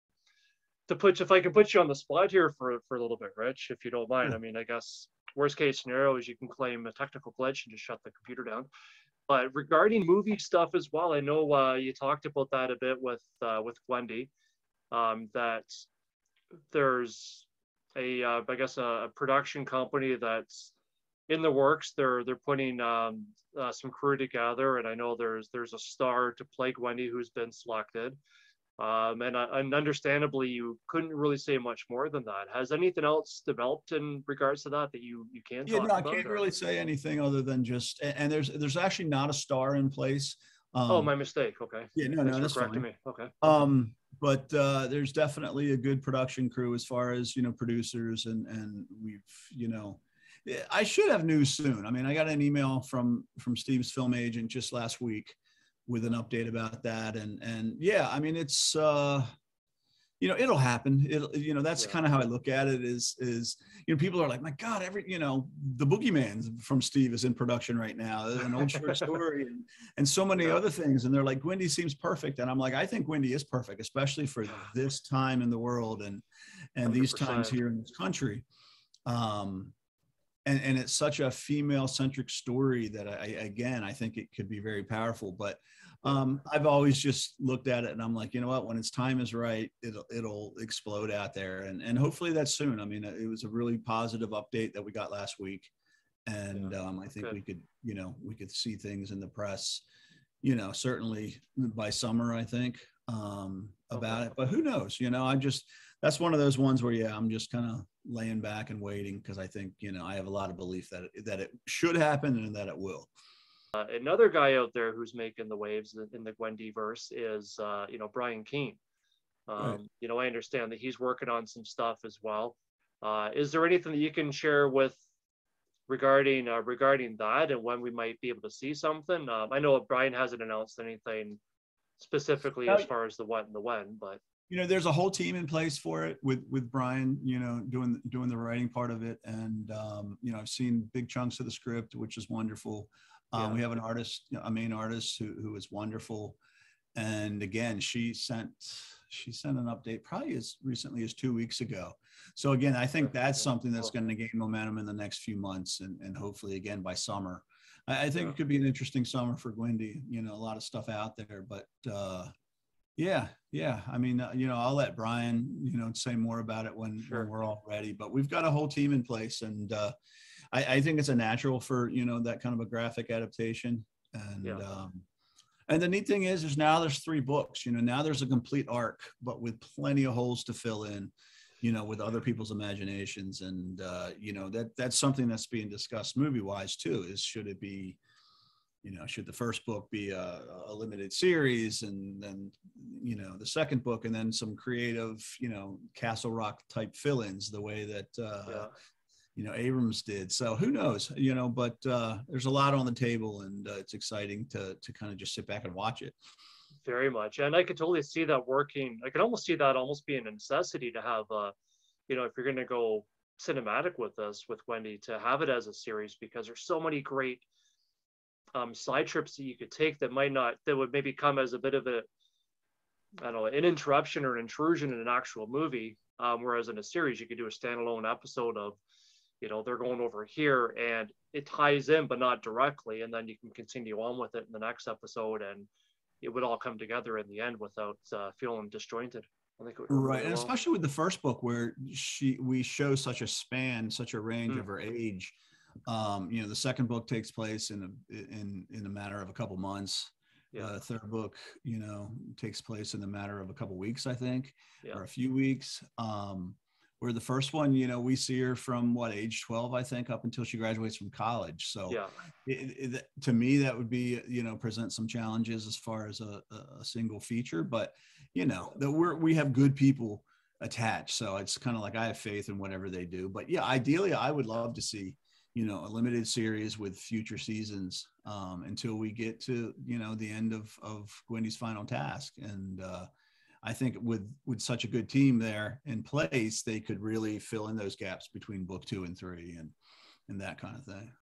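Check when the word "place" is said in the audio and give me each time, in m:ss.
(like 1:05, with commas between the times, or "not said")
0:39, 2:15, 2:49, 4:07, 4:12, 4:46.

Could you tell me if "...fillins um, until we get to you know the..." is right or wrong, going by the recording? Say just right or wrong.
wrong.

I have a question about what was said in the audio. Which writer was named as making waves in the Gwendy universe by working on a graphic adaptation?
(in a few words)
Brian Keene.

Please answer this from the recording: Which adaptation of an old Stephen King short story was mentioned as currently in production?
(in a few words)
The Boogeyman.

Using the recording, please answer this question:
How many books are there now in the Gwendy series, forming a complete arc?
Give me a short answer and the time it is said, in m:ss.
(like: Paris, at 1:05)
3, at 2:56.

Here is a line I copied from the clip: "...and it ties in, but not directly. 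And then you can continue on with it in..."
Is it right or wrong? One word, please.
right.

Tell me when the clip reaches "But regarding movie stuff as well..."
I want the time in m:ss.
0:09.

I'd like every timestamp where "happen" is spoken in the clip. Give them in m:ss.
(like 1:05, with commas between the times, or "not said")
1:00, 1:51.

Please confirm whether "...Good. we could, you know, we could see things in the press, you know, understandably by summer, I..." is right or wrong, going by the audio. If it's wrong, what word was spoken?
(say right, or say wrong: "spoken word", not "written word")
wrong: "certainly", not "understandably".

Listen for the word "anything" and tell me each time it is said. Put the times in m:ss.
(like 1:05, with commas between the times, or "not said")
0:32, 0:36, 2:03, 2:10.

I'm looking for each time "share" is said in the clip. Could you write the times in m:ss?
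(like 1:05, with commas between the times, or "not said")
2:04.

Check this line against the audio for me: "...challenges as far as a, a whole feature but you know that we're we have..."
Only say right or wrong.
wrong.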